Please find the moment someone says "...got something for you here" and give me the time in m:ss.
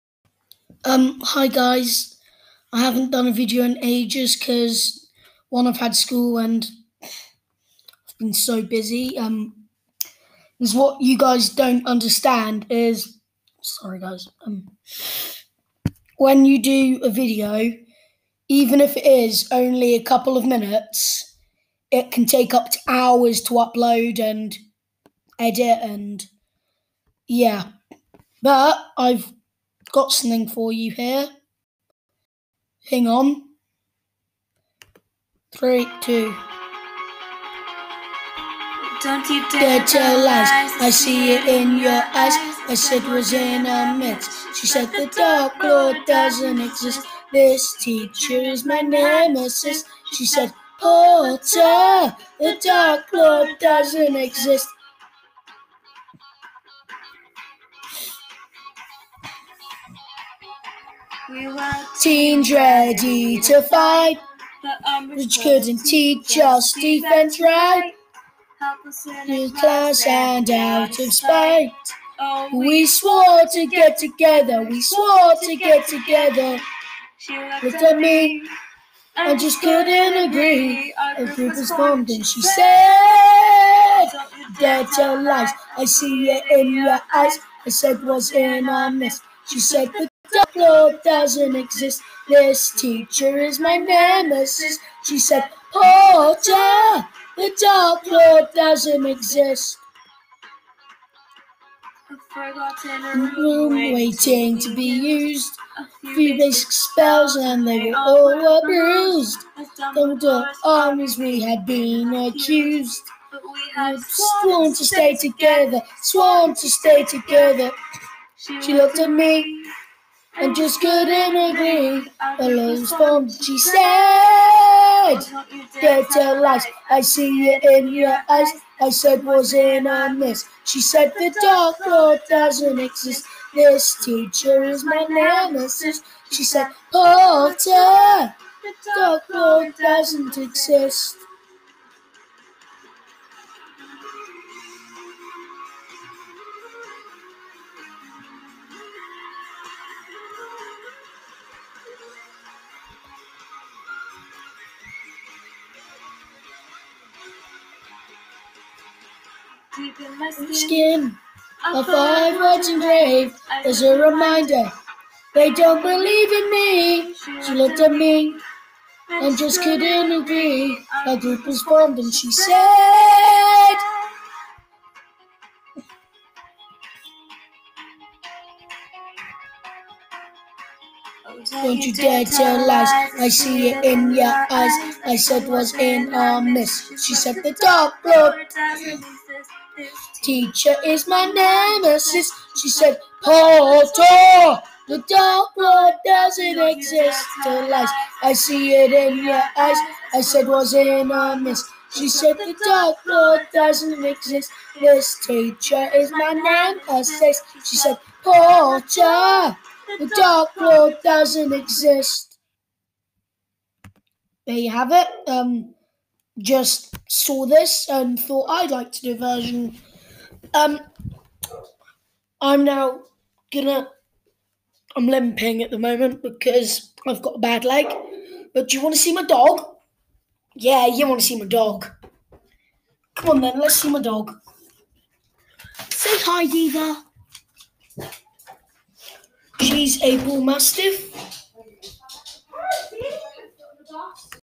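0:29.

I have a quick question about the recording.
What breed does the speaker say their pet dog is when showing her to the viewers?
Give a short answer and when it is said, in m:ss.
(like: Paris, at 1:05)
Bull mastiff, at 4:00.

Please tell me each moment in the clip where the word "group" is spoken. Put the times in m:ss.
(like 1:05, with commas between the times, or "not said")
1:21, 2:51.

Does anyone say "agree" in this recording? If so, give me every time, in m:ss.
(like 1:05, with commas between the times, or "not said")
1:20, 2:01, 2:50.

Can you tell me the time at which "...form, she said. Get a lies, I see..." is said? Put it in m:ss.
2:02.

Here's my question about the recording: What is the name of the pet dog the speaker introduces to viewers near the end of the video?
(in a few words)
Diva.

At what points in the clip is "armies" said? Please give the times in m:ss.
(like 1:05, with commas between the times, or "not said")
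1:50.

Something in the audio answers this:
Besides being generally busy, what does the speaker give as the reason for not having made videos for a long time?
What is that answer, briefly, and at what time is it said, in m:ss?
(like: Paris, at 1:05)
School, at 0:05.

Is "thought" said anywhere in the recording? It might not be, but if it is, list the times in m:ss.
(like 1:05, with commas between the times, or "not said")
3:38.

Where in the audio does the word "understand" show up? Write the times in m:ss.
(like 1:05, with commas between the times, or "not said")
0:11.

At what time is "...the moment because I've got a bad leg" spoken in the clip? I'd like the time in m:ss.
3:45.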